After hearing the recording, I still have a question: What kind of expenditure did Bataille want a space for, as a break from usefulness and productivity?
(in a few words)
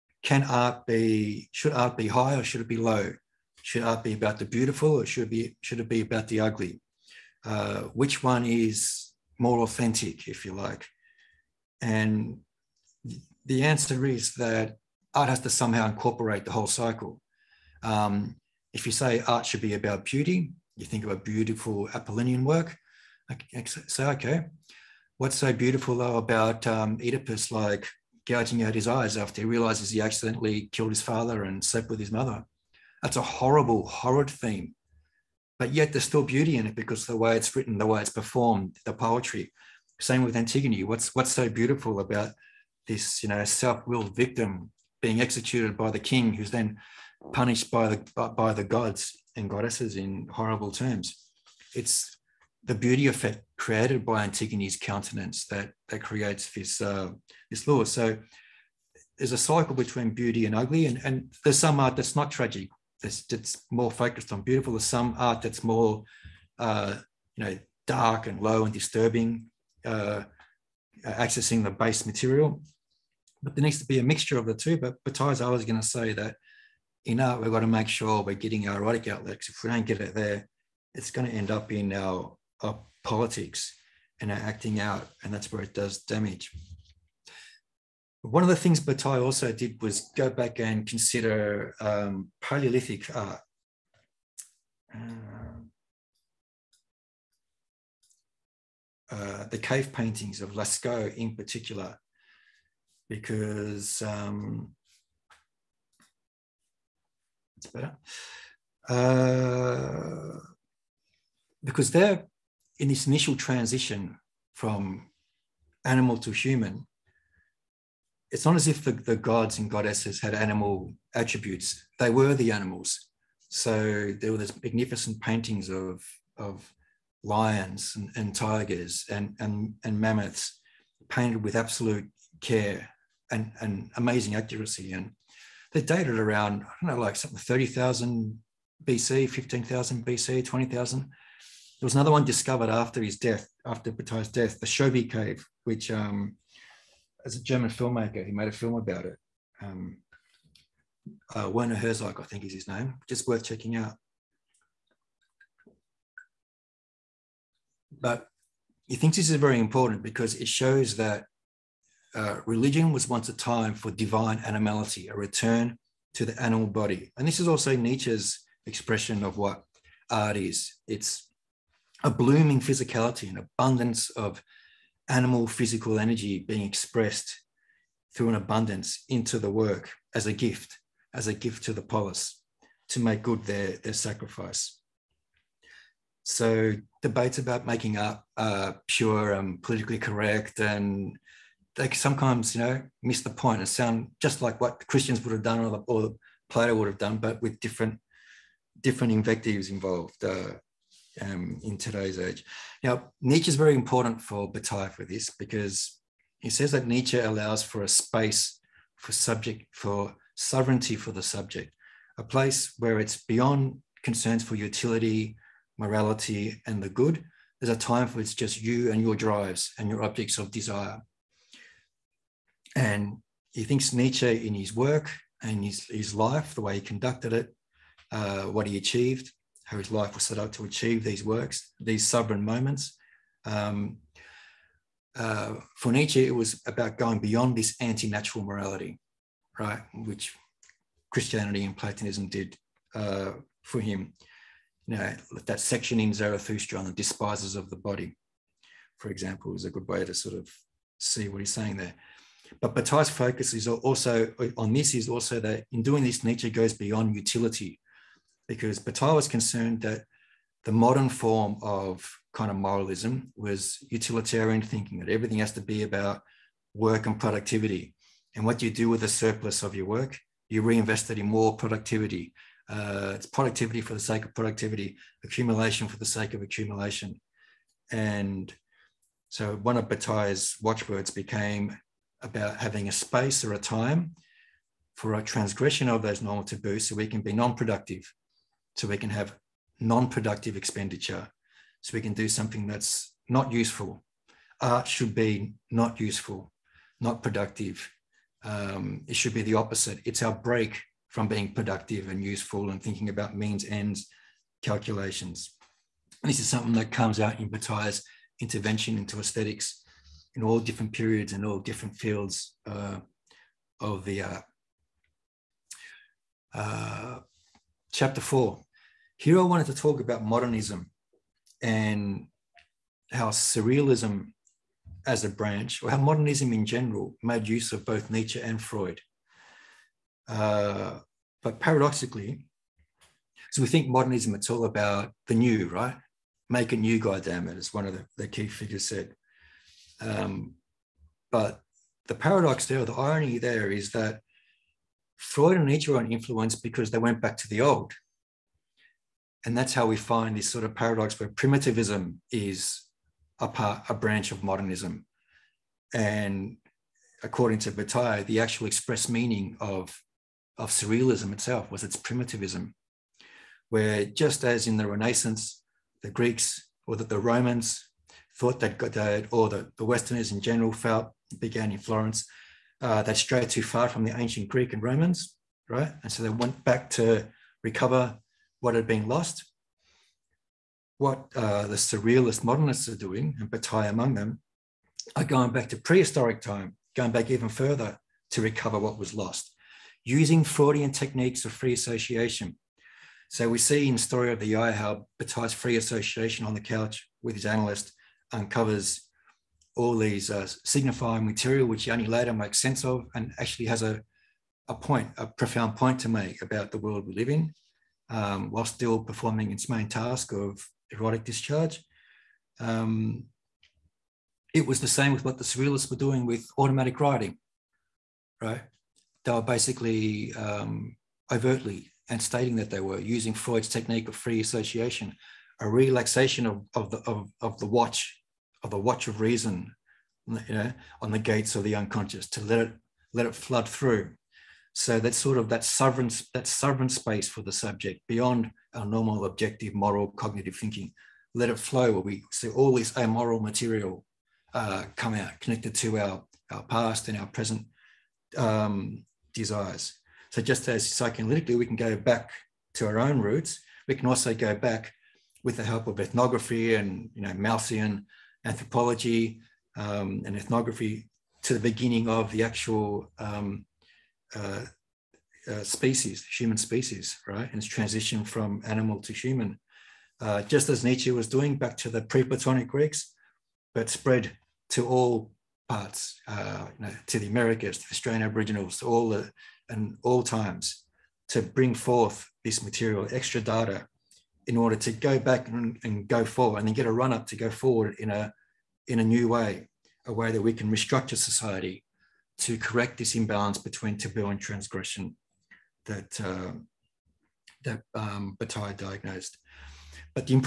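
non-productive expenditure.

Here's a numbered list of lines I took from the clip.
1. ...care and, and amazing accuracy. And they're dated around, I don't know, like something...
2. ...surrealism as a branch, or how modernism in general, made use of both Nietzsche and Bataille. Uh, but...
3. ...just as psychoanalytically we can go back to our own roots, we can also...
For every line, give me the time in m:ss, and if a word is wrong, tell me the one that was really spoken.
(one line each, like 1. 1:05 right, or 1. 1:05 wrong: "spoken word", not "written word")
1. 2:12 right
2. 5:23 wrong: "Freud", not "Bataille"
3. 7:30 right.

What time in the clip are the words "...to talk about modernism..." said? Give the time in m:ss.
5:19.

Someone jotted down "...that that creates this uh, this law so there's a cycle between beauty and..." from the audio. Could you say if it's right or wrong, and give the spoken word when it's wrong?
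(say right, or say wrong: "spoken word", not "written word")
right.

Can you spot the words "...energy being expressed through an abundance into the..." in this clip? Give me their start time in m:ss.
2:55.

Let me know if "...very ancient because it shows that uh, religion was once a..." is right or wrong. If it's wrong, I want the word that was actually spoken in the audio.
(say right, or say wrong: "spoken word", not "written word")
wrong: "important", not "ancient".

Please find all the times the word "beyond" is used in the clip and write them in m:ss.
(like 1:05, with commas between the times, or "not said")
3:33, 3:57, 4:16, 7:18.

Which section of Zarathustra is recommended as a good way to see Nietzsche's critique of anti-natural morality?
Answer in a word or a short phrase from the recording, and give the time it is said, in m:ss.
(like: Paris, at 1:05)
the despisers of the body, at 4:06.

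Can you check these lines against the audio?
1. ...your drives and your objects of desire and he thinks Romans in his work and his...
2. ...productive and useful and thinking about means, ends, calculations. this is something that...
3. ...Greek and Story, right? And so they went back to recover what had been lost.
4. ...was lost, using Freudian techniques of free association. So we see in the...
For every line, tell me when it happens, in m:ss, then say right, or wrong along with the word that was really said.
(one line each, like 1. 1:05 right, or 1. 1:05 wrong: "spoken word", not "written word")
1. 3:39 wrong: "Nietzsche", not "Romans"
2. 5:01 right
3. 6:14 wrong: "Romans", not "Story"
4. 6:28 right.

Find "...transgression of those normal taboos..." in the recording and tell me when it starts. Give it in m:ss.
4:45.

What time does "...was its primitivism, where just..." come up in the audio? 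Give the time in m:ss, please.
6:01.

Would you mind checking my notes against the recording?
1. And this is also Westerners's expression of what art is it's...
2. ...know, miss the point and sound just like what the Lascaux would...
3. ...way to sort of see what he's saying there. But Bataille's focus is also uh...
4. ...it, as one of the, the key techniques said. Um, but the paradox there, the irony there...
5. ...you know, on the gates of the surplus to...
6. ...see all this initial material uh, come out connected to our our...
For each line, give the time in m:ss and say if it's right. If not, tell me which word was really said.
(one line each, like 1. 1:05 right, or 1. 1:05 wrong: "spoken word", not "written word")
1. 2:47 wrong: "Nietzsche", not "Westerners"
2. 3:12 wrong: "Christians", not "Lascaux"
3. 4:09 right
4. 5:37 wrong: "figures", not "techniques"
5. 7:10 wrong: "unconscious", not "surplus"
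6. 7:22 wrong: "amoral", not "initial".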